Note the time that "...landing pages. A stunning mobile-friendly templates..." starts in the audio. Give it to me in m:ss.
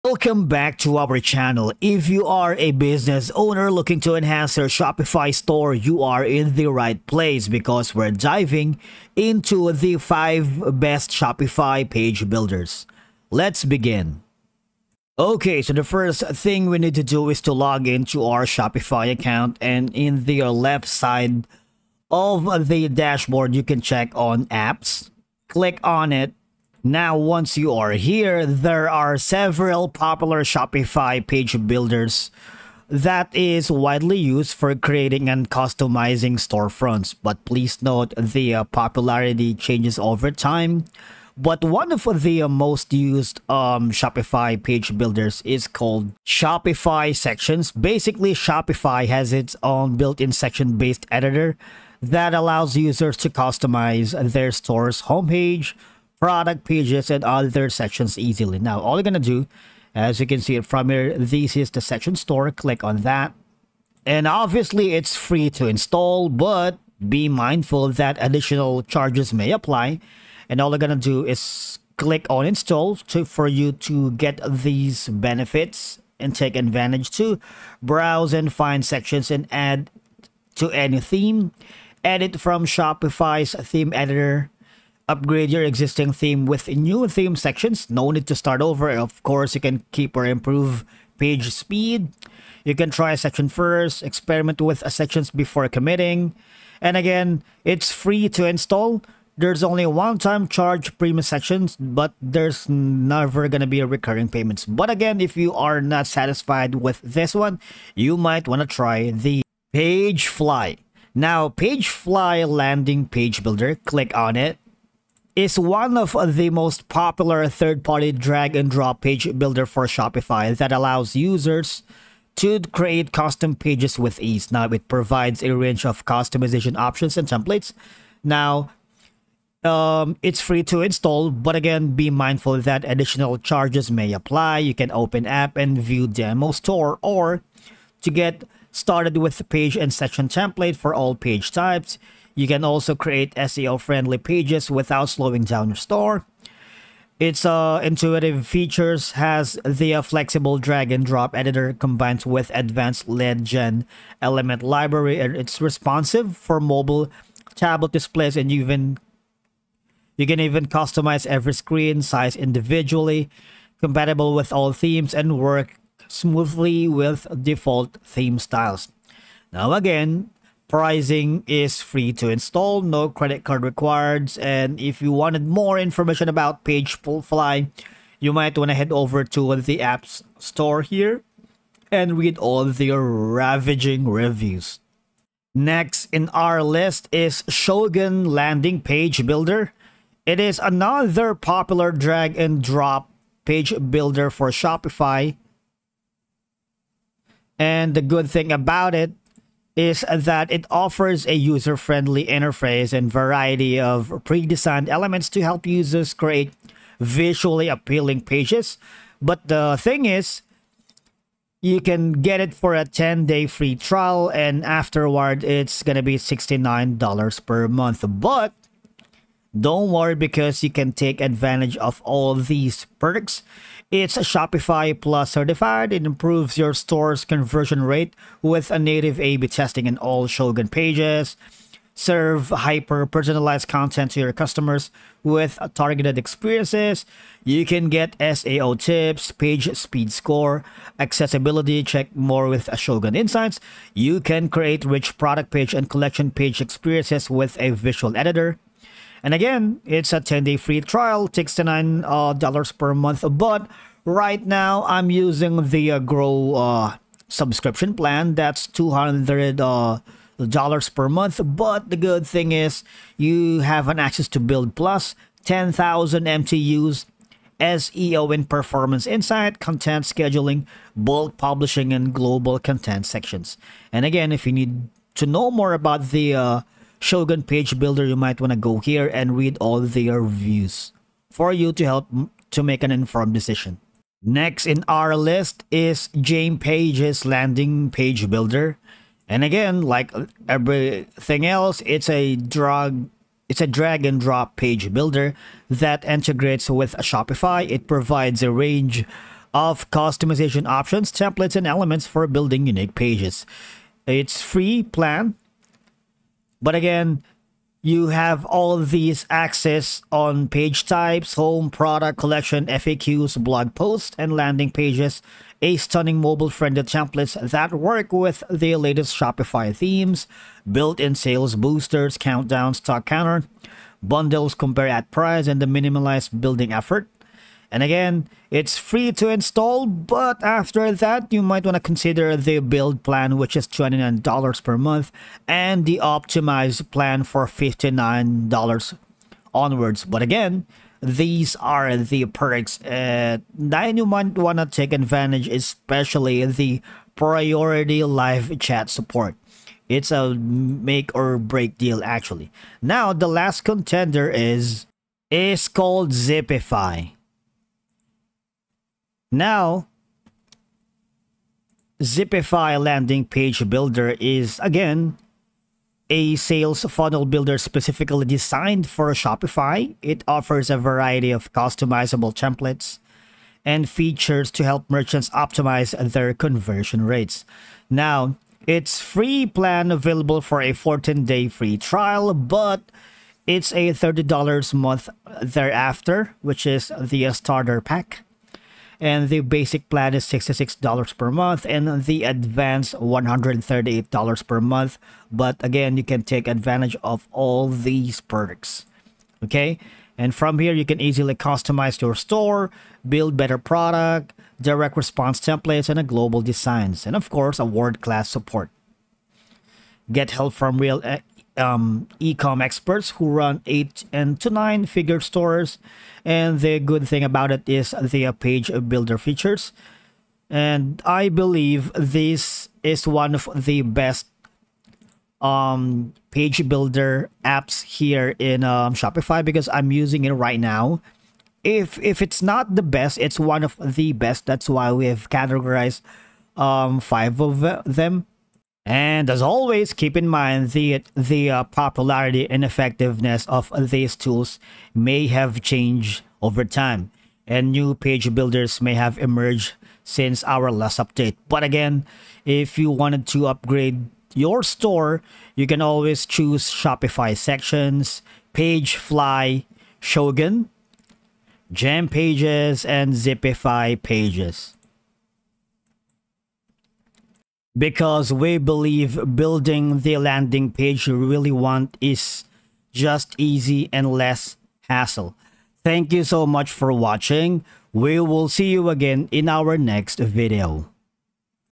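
5:14.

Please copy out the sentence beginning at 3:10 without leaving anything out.
It is another popular drag and drop page builder for Shopify.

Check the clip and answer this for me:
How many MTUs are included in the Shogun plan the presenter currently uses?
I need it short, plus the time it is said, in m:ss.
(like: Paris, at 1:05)
10,000, at 4:25.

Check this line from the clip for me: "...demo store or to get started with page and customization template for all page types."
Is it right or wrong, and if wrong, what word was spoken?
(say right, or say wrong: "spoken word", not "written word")
wrong: "section", not "customization".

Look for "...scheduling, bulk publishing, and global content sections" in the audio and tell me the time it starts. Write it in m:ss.
4:30.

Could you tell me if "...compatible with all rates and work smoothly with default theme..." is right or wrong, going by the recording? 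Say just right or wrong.
wrong.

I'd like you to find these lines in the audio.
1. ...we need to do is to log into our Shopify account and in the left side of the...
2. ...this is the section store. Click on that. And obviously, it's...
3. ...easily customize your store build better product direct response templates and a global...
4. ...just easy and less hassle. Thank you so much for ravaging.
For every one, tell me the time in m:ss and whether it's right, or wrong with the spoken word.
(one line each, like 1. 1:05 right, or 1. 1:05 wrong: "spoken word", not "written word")
1. 0:16 right
2. 1:01 right
3. 6:41 right
4. 7:52 wrong: "watching", not "ravaging".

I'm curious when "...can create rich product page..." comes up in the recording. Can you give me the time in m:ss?
4:04.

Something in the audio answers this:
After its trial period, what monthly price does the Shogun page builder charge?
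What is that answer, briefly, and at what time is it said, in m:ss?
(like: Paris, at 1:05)
$69, at 3:36.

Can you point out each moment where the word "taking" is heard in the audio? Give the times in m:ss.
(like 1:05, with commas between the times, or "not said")
not said.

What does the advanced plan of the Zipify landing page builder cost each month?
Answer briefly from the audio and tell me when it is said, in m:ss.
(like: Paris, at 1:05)
$138, at 6:32.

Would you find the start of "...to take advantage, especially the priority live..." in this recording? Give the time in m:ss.
5:44.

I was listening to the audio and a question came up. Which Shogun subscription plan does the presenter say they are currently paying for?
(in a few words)
Grow.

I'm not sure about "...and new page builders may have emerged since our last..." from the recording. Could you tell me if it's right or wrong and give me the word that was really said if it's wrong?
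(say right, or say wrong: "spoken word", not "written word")
right.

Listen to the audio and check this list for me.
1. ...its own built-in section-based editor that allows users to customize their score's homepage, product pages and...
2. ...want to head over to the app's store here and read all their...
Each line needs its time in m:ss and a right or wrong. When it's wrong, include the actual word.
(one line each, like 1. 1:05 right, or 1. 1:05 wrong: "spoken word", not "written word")
1. 0:49 wrong: "store", not "score"
2. 2:58 right.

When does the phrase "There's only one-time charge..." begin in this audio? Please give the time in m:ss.
1:39.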